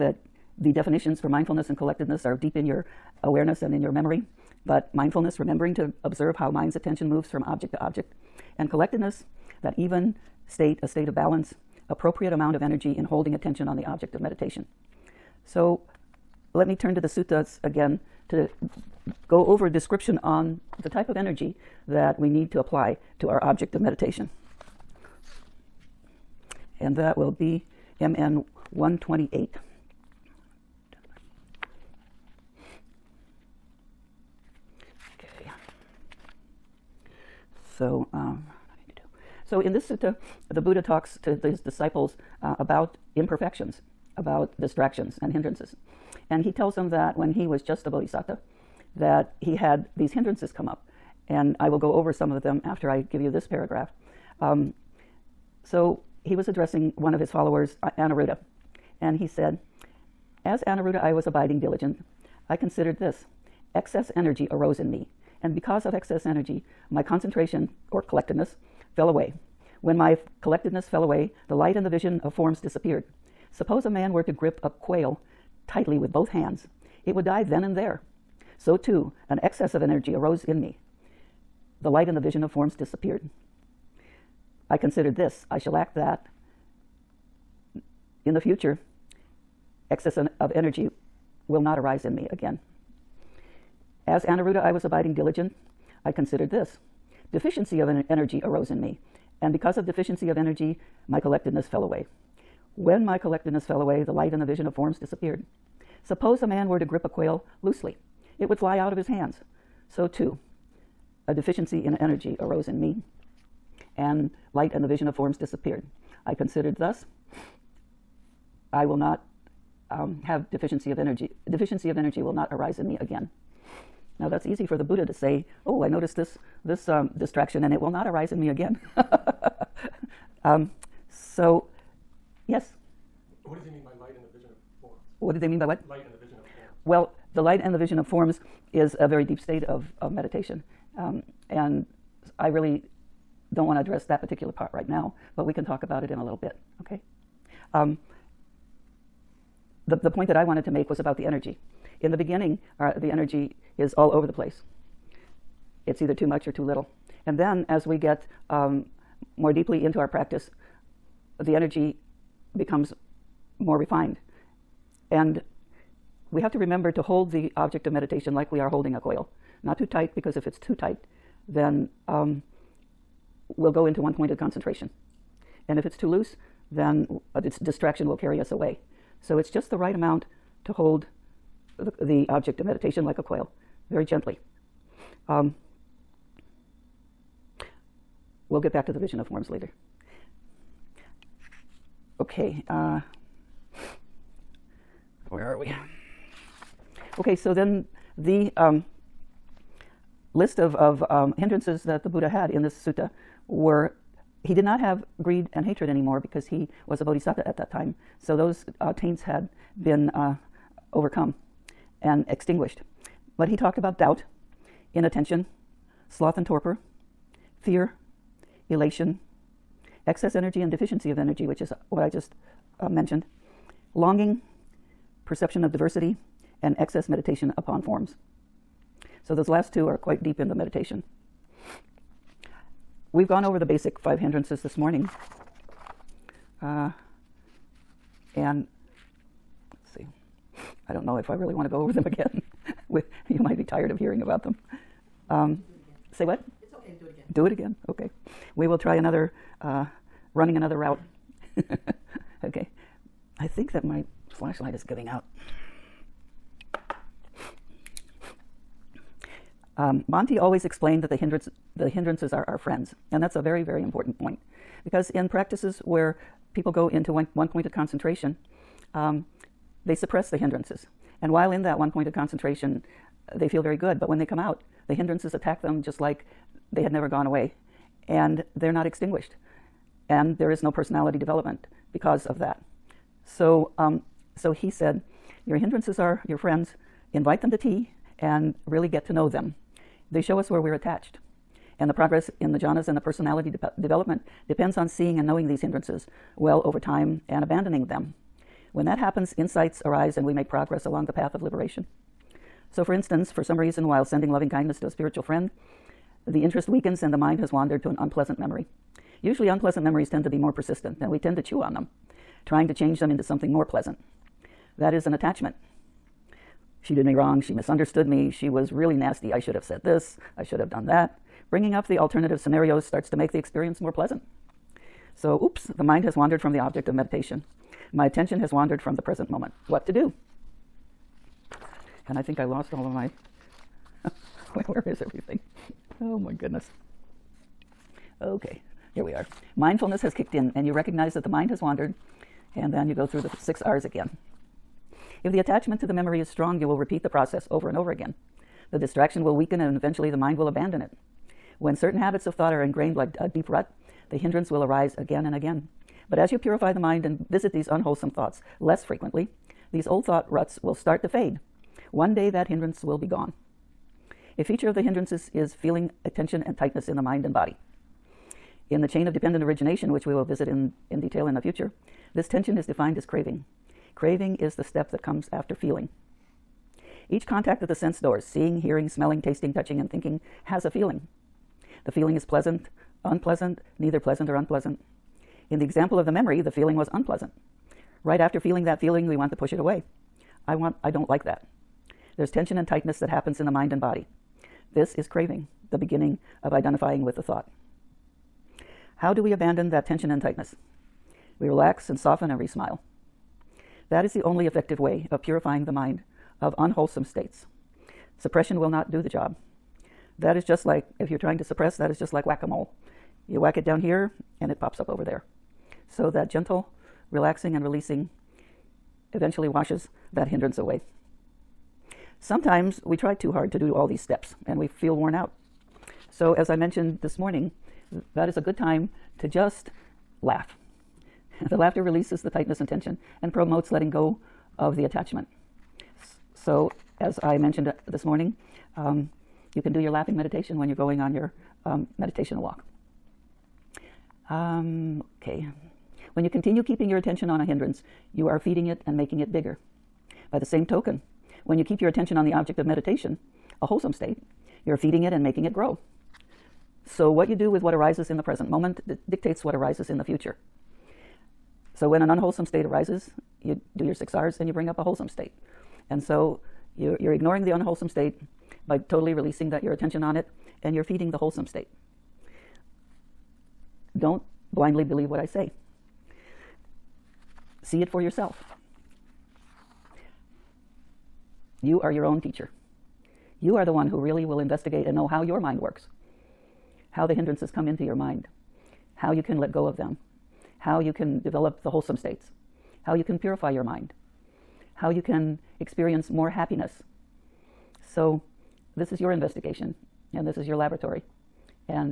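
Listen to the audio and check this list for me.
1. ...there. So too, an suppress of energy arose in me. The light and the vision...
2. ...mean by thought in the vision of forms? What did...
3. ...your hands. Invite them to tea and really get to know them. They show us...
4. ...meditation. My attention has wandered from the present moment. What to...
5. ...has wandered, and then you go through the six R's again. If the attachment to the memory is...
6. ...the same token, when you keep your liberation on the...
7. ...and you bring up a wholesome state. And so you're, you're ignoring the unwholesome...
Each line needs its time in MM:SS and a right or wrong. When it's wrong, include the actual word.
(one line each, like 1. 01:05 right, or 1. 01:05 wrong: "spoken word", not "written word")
1. 01:17 wrong: "excess", not "suppress"
2. 02:13 wrong: "light", not "thought"
3. 04:46 wrong: "friends", not "hands"
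4. 05:26 right
5. 05:41 right
6. 07:30 wrong: "attention", not "liberation"
7. 07:44 right.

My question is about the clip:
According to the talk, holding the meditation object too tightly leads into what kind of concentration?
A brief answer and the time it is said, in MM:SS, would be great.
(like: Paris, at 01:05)
one-pointed concentration, at 02:53.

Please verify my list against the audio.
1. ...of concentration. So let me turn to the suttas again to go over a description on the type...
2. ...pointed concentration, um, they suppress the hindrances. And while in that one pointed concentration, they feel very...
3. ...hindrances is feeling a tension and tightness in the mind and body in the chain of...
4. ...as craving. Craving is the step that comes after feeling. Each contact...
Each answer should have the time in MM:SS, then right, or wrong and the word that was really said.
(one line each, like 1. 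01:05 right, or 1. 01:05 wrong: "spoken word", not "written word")
1. 00:14 wrong: "meditation", not "concentration"
2. 04:27 right
3. 06:04 right
4. 06:12 right.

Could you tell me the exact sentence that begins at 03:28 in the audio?
So those uh, taints had been uh, overcome and extinguished.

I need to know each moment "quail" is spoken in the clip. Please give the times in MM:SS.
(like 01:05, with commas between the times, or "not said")
01:14, 01:47, 02:48, 03:03.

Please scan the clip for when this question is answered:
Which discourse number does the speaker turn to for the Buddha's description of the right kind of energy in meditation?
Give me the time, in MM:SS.
00:27.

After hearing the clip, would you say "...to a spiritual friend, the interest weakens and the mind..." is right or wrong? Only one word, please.
right.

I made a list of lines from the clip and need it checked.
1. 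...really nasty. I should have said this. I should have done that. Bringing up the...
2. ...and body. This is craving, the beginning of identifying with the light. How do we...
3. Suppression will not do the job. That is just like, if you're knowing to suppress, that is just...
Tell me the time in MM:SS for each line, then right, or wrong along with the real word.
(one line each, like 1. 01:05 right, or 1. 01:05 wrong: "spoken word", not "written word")
1. 05:18 right
2. 06:33 wrong: "thought", not "light"
3. 06:48 wrong: "trying", not "knowing".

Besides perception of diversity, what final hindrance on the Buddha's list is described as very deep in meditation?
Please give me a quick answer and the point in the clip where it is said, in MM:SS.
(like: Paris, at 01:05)
excess meditation upon forms, at 03:46.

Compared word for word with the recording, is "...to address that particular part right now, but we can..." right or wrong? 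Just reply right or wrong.
right.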